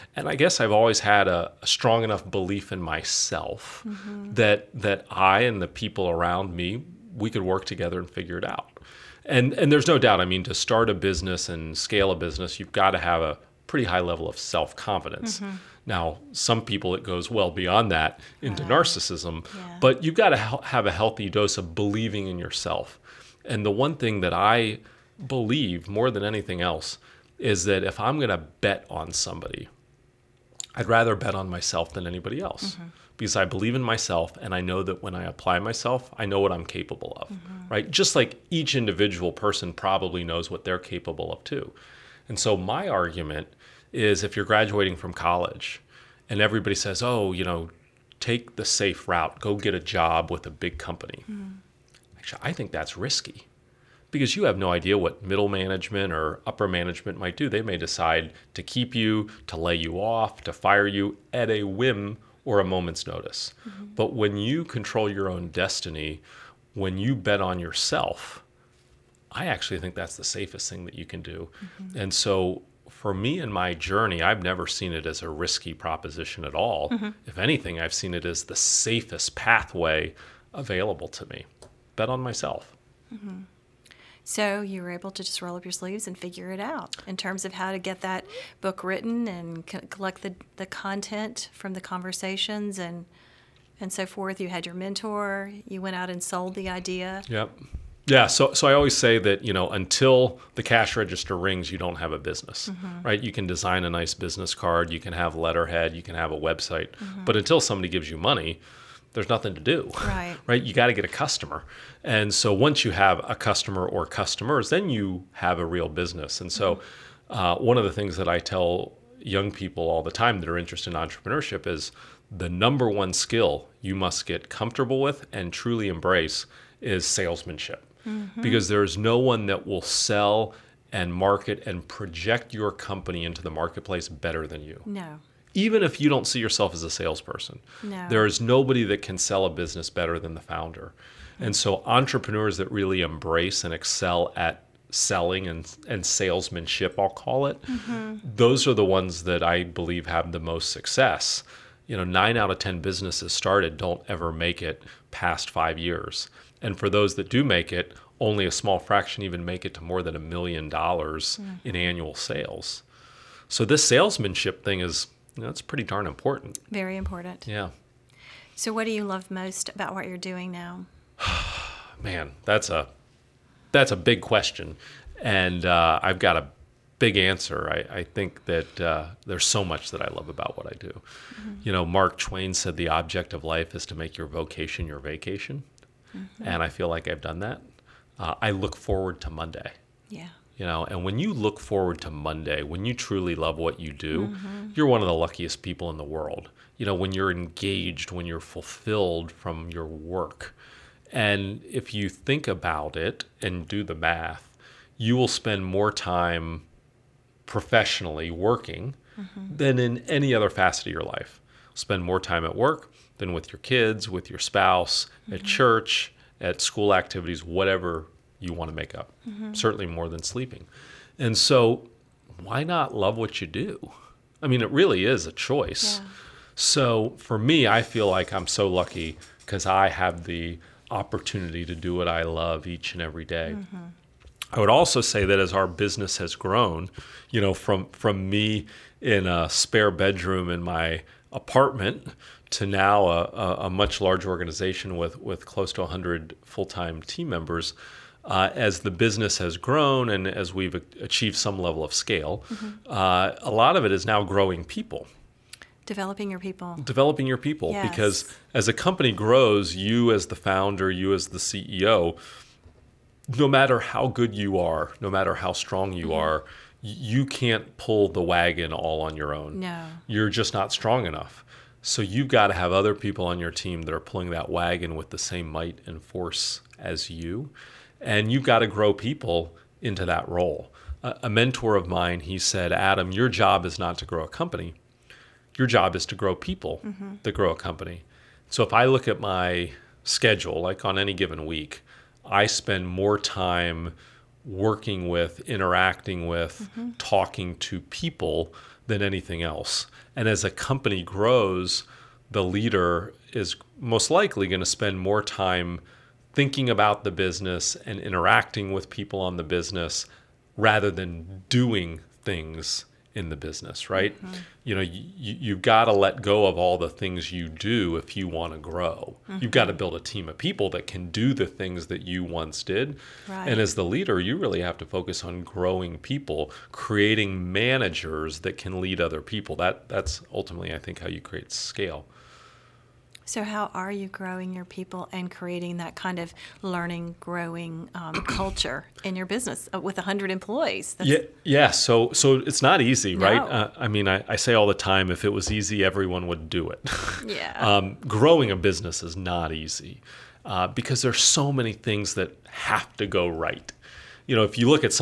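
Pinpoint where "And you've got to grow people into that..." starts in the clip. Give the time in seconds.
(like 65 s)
278 s.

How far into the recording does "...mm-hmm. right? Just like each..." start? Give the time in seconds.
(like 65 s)
37 s.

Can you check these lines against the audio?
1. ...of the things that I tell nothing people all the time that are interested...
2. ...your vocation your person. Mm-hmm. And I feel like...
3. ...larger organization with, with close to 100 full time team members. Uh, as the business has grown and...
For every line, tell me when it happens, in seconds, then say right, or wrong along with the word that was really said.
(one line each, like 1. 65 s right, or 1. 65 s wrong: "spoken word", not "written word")
1. 117 s wrong: "young", not "nothing"
2. 184 s wrong: "vacation", not "person"
3. 244 s right.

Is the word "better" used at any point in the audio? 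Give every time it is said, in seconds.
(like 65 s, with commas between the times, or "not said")
134 s, 139 s.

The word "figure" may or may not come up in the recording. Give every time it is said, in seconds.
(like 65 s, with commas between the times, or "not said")
8 s, 86 s.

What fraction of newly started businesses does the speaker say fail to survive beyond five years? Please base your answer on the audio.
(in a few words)
9 out of 10.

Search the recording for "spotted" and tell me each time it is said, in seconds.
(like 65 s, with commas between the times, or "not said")
not said.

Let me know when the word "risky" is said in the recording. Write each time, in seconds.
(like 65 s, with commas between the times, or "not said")
52 s, 75 s.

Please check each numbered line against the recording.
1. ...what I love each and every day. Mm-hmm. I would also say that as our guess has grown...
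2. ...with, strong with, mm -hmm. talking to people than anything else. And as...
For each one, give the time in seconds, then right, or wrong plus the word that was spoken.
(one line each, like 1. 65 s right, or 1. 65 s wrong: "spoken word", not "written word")
1. 231 s wrong: "business", not "guess"
2. 295 s wrong: "interacting", not "strong".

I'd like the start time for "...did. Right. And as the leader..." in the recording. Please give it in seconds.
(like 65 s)
322 s.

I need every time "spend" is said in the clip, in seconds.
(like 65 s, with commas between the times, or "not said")
205 s, 211 s, 292 s, 304 s.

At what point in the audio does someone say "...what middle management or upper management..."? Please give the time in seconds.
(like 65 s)
54 s.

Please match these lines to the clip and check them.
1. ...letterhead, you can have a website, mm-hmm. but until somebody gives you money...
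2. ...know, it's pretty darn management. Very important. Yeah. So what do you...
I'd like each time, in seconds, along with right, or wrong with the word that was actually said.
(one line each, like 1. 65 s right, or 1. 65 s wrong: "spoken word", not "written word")
1. 105 s right
2. 165 s wrong: "important", not "management".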